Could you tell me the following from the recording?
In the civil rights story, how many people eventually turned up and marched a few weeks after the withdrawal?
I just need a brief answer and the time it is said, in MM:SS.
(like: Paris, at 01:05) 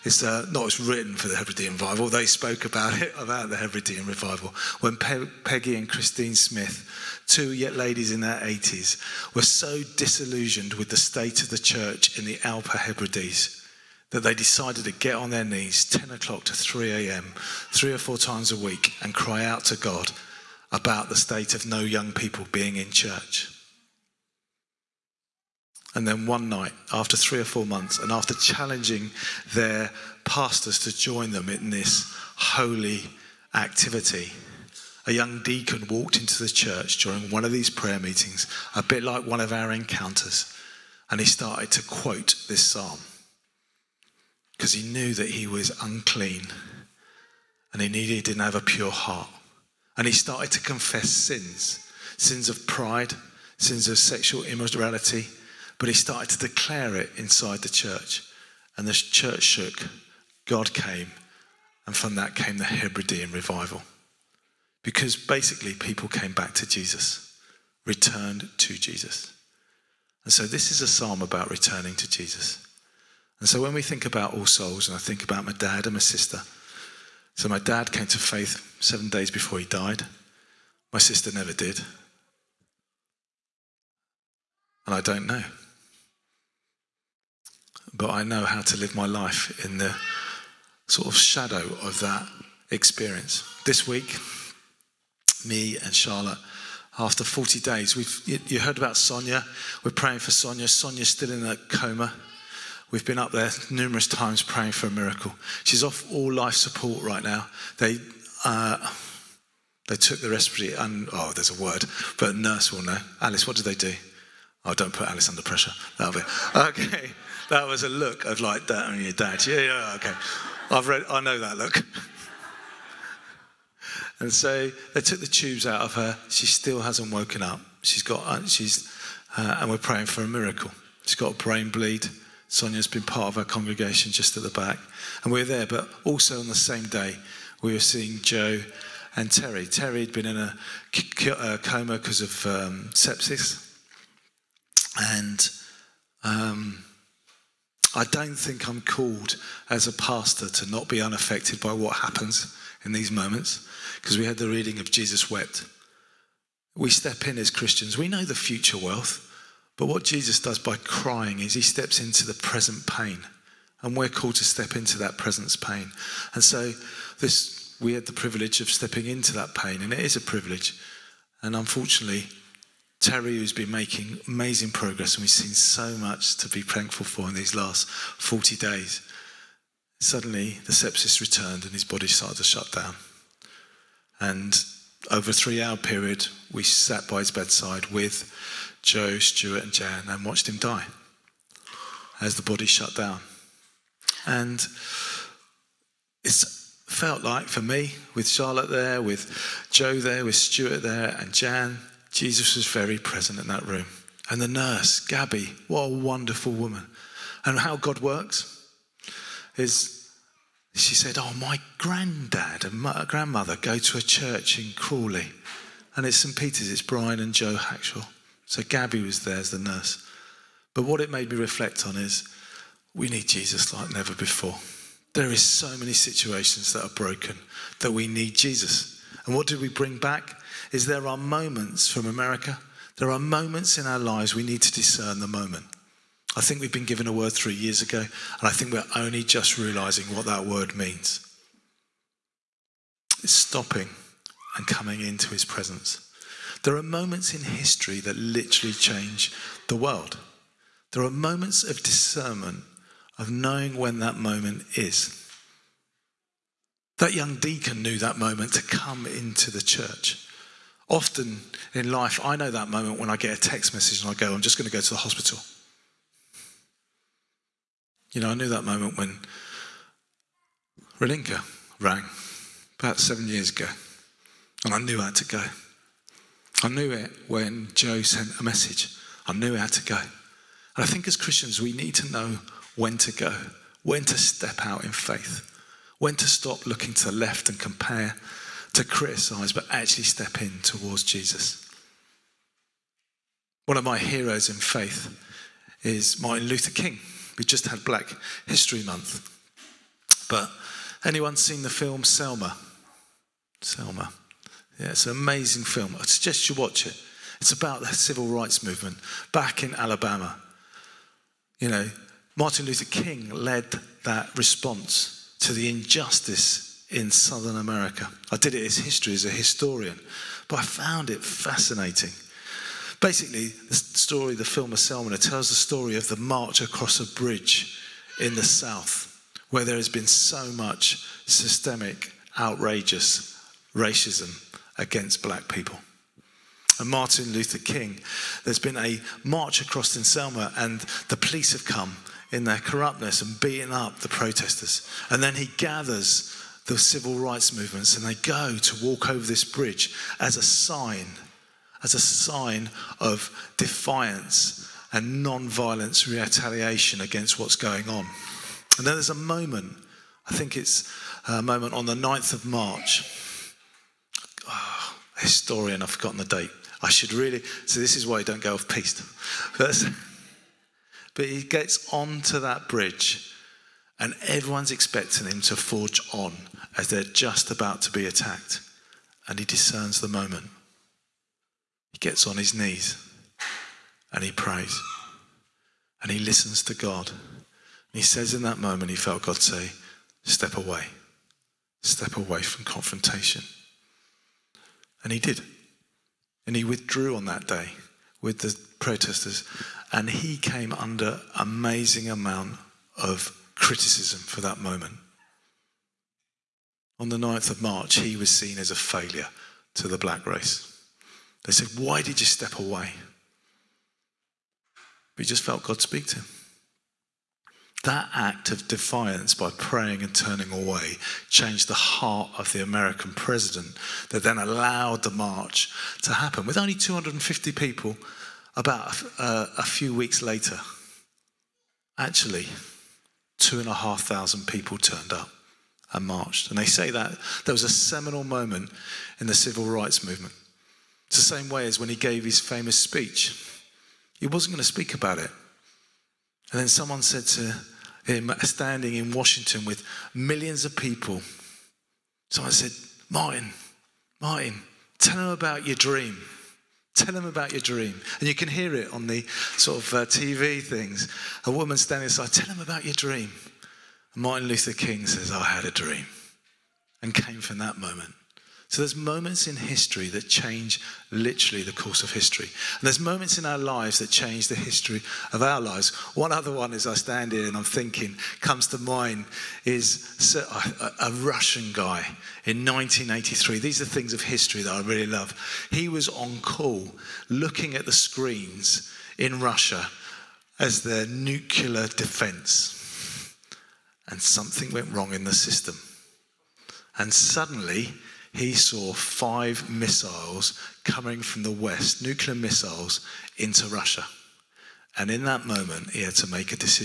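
2,500, at 07:13.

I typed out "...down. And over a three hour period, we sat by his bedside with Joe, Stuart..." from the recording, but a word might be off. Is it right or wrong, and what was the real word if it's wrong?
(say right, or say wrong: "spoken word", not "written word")
right.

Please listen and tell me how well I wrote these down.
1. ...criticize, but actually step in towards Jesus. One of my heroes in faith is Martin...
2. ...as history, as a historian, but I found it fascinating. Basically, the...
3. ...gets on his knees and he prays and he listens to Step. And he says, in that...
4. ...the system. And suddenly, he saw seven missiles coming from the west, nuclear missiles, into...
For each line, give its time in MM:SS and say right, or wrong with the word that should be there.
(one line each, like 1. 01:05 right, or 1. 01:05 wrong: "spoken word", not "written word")
1. 04:48 right
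2. 05:18 right
3. 06:21 wrong: "God", not "Step"
4. 08:15 wrong: "five", not "seven".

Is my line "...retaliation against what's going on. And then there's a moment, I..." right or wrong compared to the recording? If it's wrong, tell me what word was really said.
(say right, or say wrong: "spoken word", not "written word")
right.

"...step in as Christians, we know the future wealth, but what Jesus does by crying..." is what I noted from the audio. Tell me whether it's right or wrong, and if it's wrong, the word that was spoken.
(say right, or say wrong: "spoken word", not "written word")
right.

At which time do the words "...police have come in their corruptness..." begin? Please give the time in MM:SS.
05:41.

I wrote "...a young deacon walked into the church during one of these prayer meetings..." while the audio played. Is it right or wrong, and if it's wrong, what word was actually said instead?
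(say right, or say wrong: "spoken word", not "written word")
right.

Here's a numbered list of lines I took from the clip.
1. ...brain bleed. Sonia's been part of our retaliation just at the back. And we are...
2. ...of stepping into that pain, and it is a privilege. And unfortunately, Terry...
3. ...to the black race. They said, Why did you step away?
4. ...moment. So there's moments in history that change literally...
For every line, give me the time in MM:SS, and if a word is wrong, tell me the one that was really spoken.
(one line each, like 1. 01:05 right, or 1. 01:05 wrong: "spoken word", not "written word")
1. 02:11 wrong: "congregation", not "retaliation"
2. 02:48 right
3. 06:49 right
4. 07:47 right.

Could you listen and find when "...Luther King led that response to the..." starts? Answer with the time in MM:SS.
05:12.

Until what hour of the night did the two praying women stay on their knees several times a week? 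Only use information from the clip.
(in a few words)
3 a.m.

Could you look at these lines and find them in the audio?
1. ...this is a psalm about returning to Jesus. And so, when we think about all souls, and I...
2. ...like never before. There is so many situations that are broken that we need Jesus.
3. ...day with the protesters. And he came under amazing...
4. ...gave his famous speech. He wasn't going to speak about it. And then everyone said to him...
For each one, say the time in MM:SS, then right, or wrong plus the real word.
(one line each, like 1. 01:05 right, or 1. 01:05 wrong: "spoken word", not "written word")
1. 01:10 right
2. 03:43 right
3. 06:37 right
4. 07:21 wrong: "someone", not "everyone".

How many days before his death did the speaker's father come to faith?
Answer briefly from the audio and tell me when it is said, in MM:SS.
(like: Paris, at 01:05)
7, at 01:18.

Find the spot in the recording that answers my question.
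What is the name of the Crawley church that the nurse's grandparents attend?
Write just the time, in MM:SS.
03:36.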